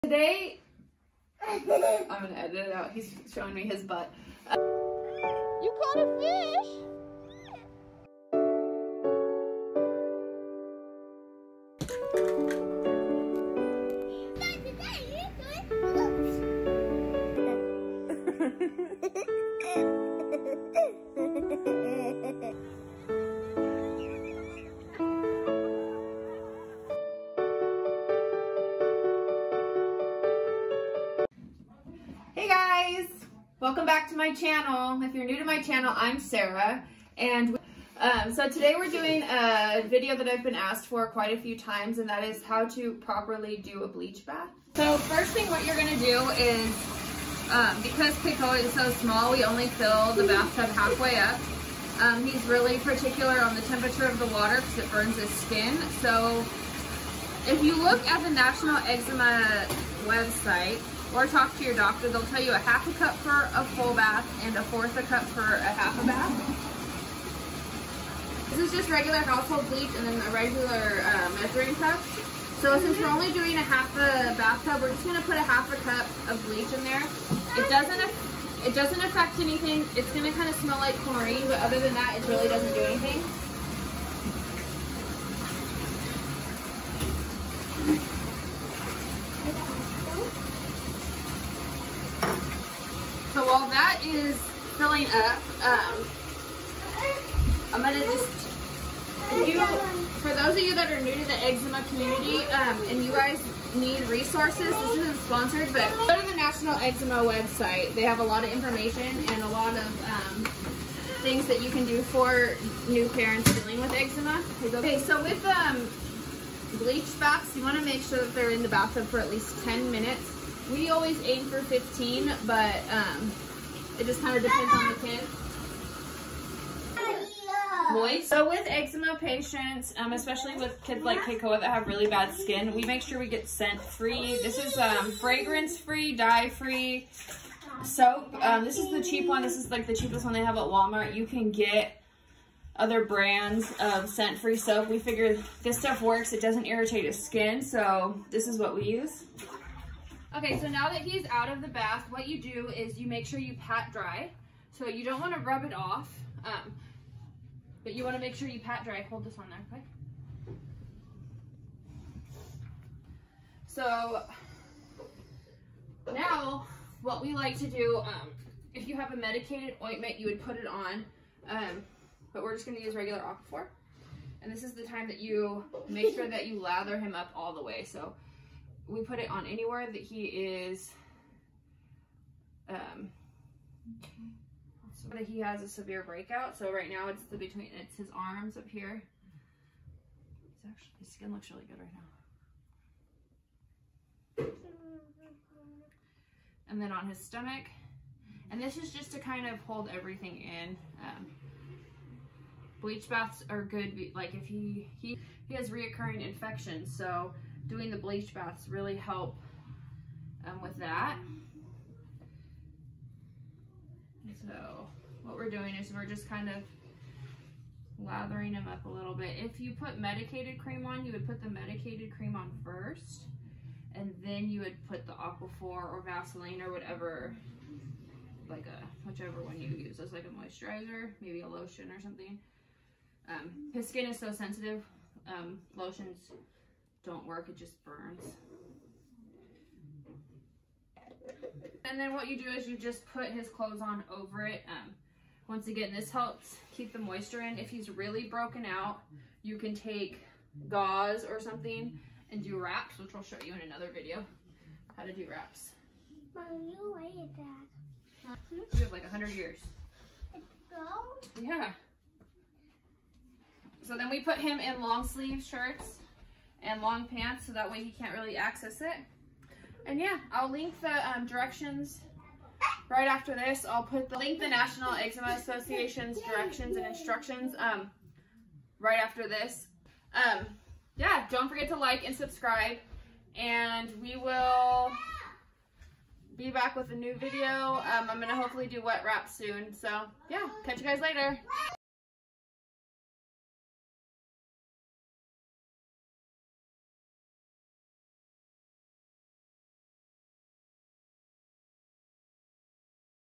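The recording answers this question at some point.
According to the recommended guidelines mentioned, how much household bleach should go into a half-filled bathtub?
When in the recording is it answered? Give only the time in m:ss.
1:04.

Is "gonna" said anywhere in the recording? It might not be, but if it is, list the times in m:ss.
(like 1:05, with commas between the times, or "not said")
0:01, 0:45, 1:15, 1:20, 1:37.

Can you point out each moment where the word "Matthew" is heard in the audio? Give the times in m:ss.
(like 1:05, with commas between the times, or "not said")
not said.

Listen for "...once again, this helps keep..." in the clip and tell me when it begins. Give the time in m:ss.
4:05.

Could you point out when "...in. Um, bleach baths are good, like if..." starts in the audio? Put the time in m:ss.
3:20.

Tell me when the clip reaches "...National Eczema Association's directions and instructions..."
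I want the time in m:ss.
4:34.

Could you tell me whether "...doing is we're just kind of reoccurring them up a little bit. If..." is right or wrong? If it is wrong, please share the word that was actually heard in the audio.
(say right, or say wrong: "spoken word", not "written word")
wrong: "lathering", not "reoccurring".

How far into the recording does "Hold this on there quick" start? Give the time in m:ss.
2:39.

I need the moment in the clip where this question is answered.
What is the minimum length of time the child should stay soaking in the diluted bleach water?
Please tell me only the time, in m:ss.
1:59.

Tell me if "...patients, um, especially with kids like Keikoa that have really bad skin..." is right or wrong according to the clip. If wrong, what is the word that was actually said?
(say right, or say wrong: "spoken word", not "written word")
right.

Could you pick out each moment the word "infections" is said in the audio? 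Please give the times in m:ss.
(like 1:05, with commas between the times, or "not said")
3:26.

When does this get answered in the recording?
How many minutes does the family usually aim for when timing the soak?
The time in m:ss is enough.
2:01.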